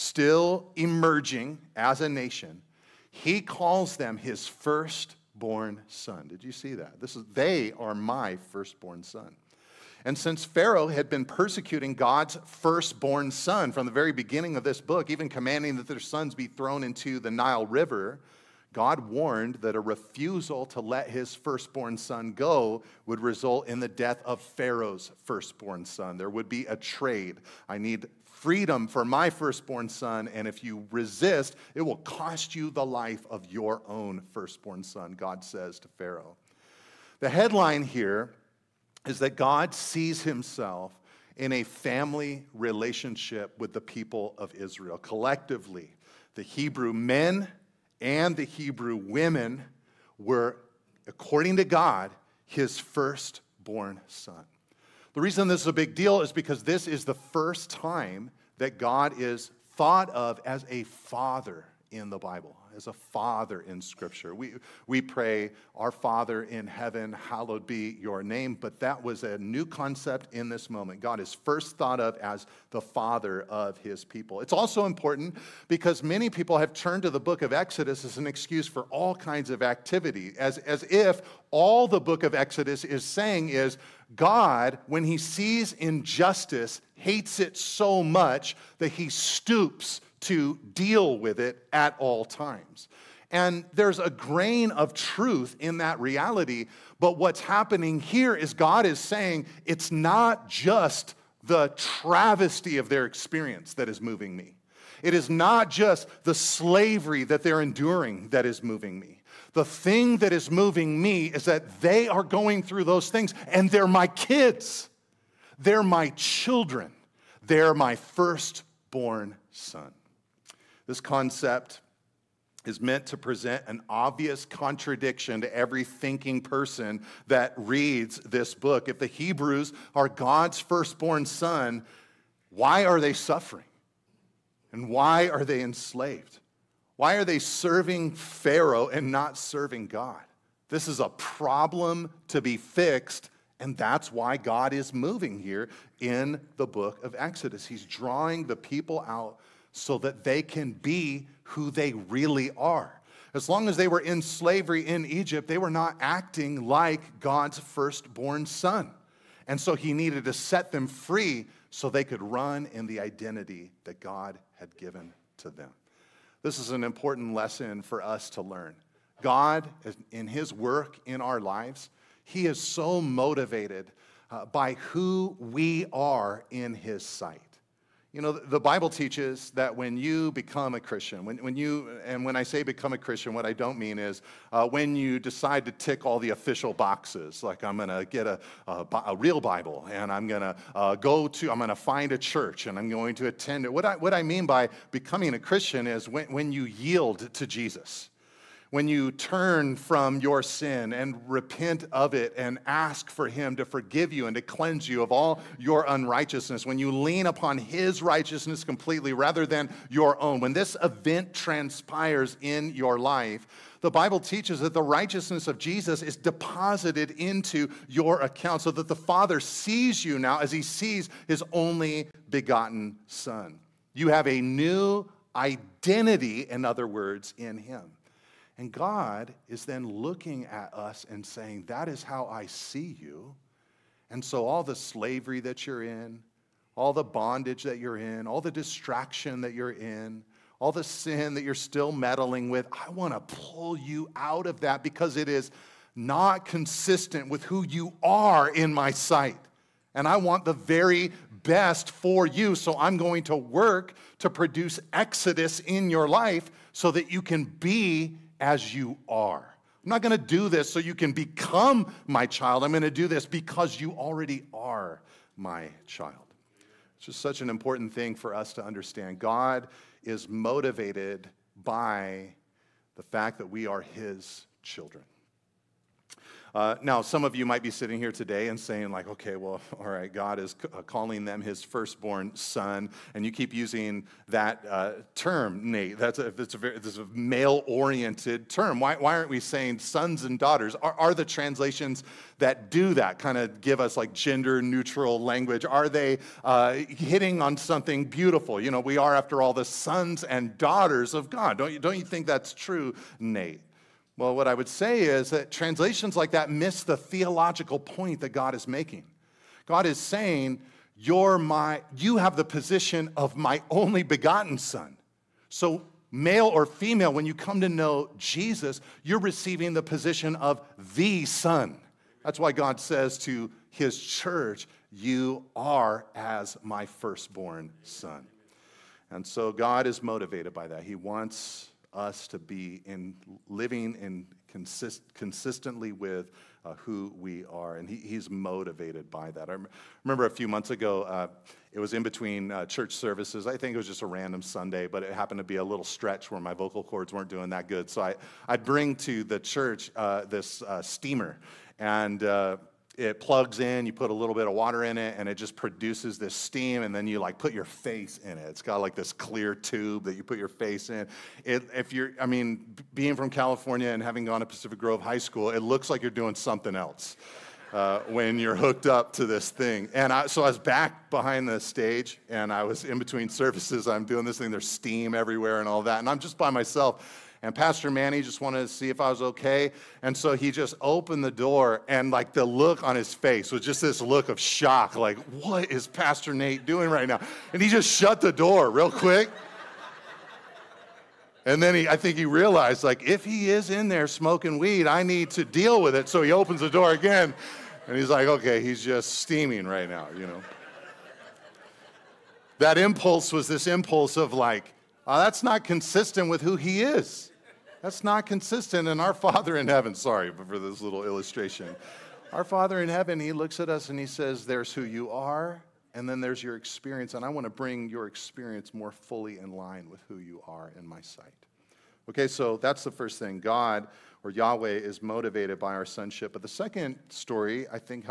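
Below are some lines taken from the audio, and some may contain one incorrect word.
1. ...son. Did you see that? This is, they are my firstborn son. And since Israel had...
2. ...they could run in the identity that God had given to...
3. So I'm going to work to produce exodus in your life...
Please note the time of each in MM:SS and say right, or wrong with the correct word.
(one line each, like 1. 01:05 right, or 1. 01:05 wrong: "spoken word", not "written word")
1. 00:05 wrong: "Pharaoh", not "Israel"
2. 02:41 right
3. 04:12 right.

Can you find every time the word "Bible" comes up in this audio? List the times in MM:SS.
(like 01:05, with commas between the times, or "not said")
01:02, 02:58, 03:09, 03:33.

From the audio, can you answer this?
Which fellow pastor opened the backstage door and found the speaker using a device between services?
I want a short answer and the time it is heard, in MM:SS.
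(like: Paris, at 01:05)
Pastor Manny, at 06:17.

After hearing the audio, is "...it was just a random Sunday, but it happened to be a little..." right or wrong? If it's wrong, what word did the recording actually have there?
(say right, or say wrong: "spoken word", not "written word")
right.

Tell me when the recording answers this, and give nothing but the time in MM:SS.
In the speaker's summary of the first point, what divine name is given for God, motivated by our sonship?
07:04.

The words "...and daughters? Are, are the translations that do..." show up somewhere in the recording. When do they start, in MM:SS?
04:50.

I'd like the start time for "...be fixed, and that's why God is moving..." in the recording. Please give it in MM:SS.
02:22.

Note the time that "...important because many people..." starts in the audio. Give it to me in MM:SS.
01:14.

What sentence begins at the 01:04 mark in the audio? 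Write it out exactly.
We, we pray, Our Father in heaven, hallowed be your name, but that was a new concept in this moment.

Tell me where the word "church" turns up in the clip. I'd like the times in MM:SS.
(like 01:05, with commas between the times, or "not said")
03:12, 05:24, 05:42, 05:49.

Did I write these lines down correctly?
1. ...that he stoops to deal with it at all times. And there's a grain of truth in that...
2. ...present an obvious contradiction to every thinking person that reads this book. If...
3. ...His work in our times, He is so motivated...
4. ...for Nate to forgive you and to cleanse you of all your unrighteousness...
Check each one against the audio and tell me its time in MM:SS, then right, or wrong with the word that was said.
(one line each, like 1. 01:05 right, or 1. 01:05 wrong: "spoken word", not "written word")
1. 01:28 right
2. 02:03 right
3. 02:50 wrong: "lives", not "times"
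4. 03:23 wrong: "Him", not "Nate".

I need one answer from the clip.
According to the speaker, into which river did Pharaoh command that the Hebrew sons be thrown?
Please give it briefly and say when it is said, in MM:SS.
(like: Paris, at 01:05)
Nile River, at 00:17.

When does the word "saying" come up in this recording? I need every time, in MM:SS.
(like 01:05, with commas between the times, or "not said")
01:23, 01:38, 03:51, 04:38, 04:49, 05:09.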